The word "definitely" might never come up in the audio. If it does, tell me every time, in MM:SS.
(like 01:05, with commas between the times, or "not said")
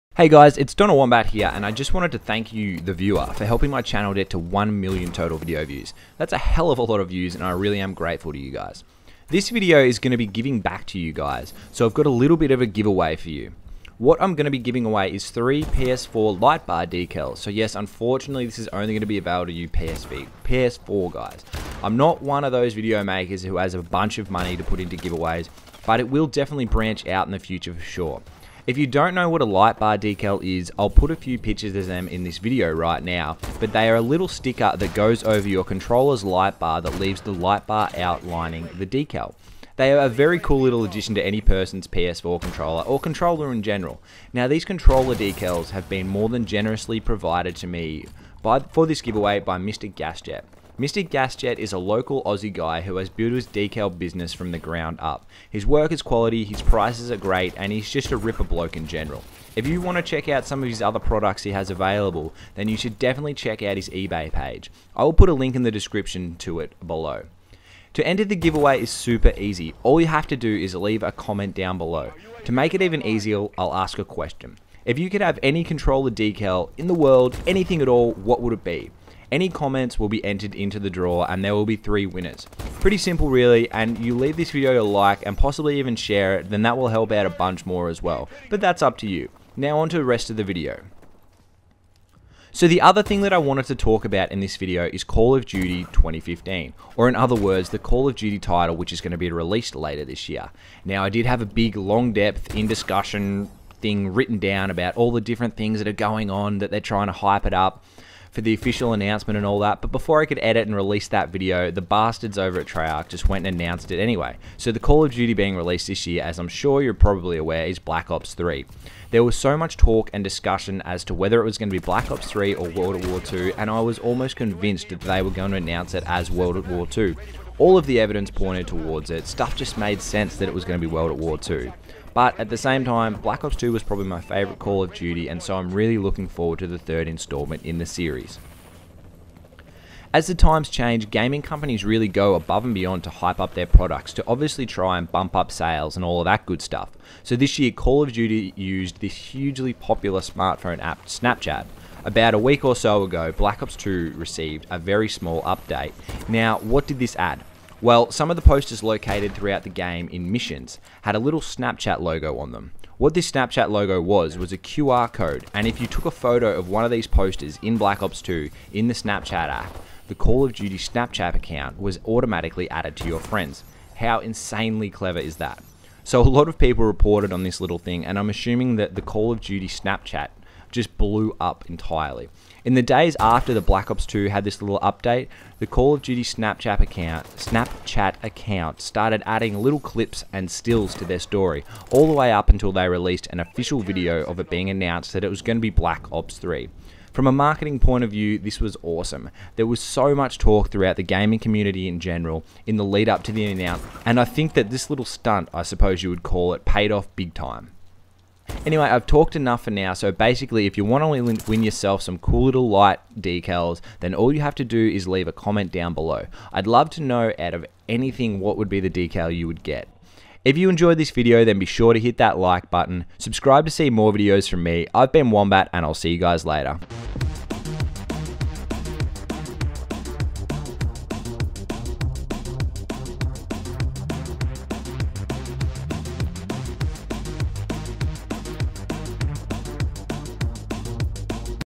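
00:26, 01:02.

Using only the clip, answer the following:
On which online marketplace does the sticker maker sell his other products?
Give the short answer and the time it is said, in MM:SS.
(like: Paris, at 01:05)
eBay, at 01:03.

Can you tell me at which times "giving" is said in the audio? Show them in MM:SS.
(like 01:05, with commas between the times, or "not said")
00:10, 00:14.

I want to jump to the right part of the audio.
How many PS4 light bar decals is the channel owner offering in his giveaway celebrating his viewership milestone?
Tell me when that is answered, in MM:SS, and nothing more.
00:15.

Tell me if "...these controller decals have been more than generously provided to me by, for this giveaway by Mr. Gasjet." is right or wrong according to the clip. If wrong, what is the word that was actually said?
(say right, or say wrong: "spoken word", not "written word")
right.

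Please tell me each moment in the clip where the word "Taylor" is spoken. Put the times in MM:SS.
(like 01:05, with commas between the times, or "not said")
not said.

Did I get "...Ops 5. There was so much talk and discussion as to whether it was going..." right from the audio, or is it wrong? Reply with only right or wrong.
wrong.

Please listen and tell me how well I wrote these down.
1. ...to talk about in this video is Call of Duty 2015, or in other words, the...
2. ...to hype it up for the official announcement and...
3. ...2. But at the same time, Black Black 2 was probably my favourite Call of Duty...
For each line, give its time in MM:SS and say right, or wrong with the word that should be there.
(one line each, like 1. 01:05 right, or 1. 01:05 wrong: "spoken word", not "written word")
1. 01:33 right
2. 01:47 right
3. 02:11 wrong: "Ops", not "Black".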